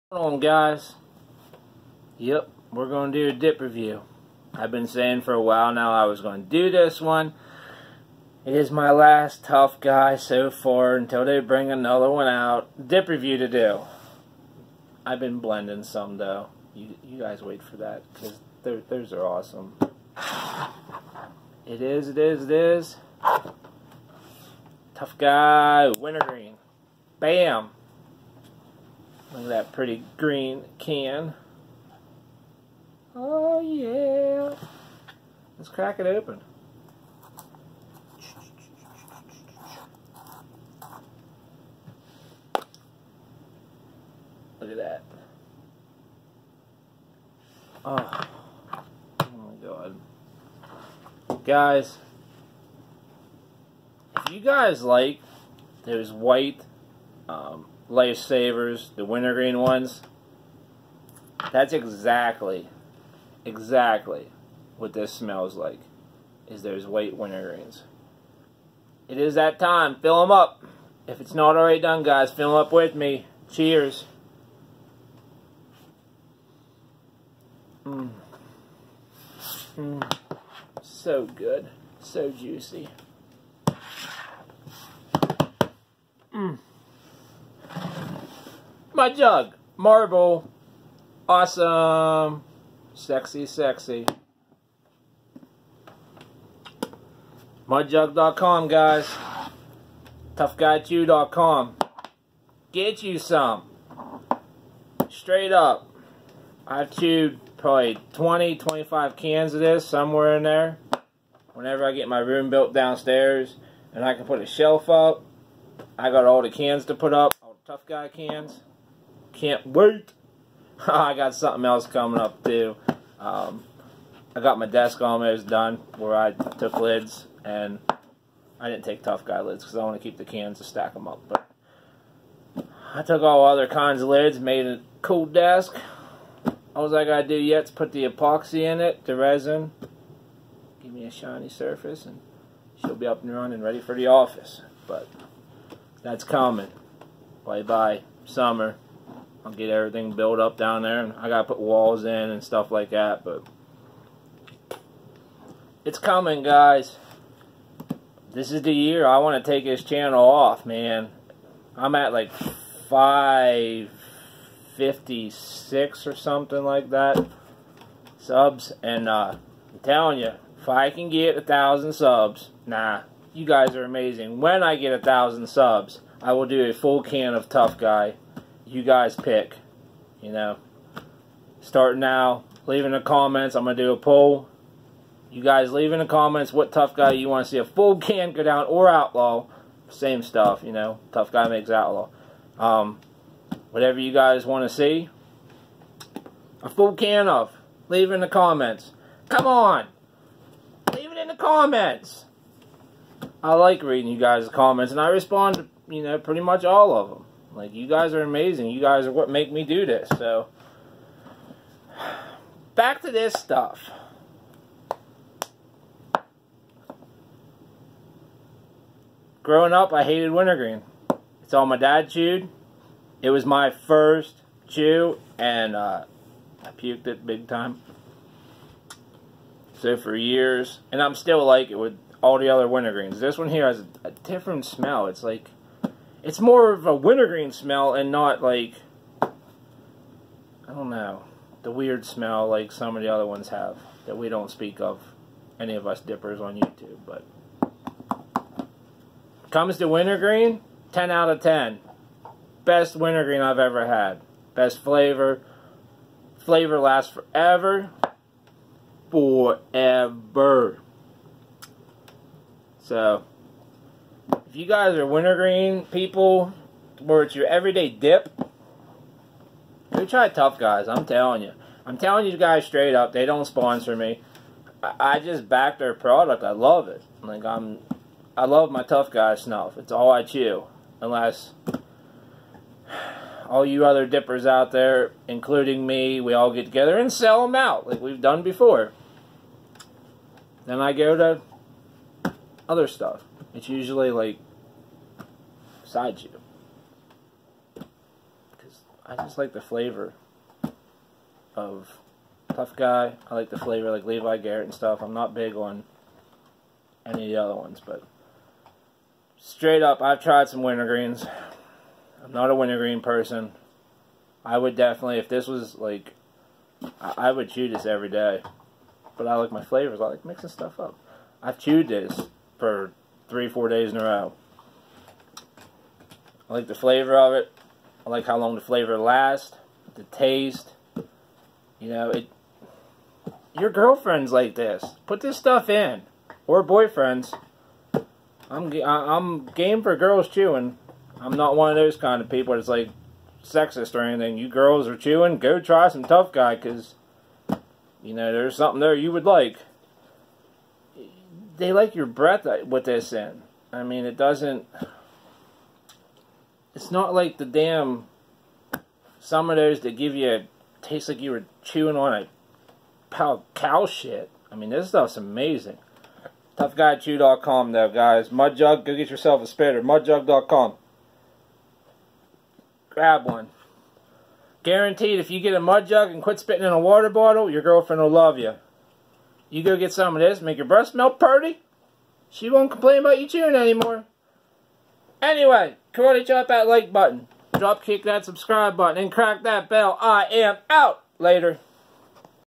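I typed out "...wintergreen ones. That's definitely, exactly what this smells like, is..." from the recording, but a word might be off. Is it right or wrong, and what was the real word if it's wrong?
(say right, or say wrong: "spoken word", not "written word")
wrong: "exactly", not "definitely".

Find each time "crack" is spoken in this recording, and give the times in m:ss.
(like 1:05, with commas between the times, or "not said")
0:35, 6:29.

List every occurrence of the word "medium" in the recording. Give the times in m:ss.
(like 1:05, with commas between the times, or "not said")
not said.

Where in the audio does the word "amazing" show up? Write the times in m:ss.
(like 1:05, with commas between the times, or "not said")
2:53, 3:28, 6:05.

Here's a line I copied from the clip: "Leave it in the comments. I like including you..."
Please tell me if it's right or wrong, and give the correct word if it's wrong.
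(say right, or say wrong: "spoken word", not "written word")
wrong: "reading", not "including".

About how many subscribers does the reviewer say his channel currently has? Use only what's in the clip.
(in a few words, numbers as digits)
556.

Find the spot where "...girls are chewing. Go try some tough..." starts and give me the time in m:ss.
5:44.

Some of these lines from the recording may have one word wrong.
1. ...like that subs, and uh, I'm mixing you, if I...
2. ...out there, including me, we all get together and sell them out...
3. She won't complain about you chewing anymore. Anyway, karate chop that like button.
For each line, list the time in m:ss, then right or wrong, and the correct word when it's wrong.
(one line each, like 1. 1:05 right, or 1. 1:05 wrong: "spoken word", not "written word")
1. 2:46 wrong: "telling", not "mixing"
2. 4:44 right
3. 6:22 right.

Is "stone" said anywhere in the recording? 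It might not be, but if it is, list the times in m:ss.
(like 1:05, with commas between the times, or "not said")
not said.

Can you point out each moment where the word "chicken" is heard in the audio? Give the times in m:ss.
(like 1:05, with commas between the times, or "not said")
not said.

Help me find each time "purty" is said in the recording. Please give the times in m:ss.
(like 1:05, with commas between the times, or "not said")
6:21.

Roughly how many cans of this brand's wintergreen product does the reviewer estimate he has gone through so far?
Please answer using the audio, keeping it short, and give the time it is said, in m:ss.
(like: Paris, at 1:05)
20 to 25, at 1:48.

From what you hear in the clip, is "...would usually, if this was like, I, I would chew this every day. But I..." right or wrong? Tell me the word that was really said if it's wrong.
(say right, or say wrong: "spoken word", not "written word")
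wrong: "definitely", not "usually".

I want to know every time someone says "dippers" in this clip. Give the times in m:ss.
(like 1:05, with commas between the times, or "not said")
4:06, 4:44.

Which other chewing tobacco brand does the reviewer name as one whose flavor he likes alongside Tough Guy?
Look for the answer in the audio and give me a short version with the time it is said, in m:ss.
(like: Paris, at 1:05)
Levi Garrett, at 5:04.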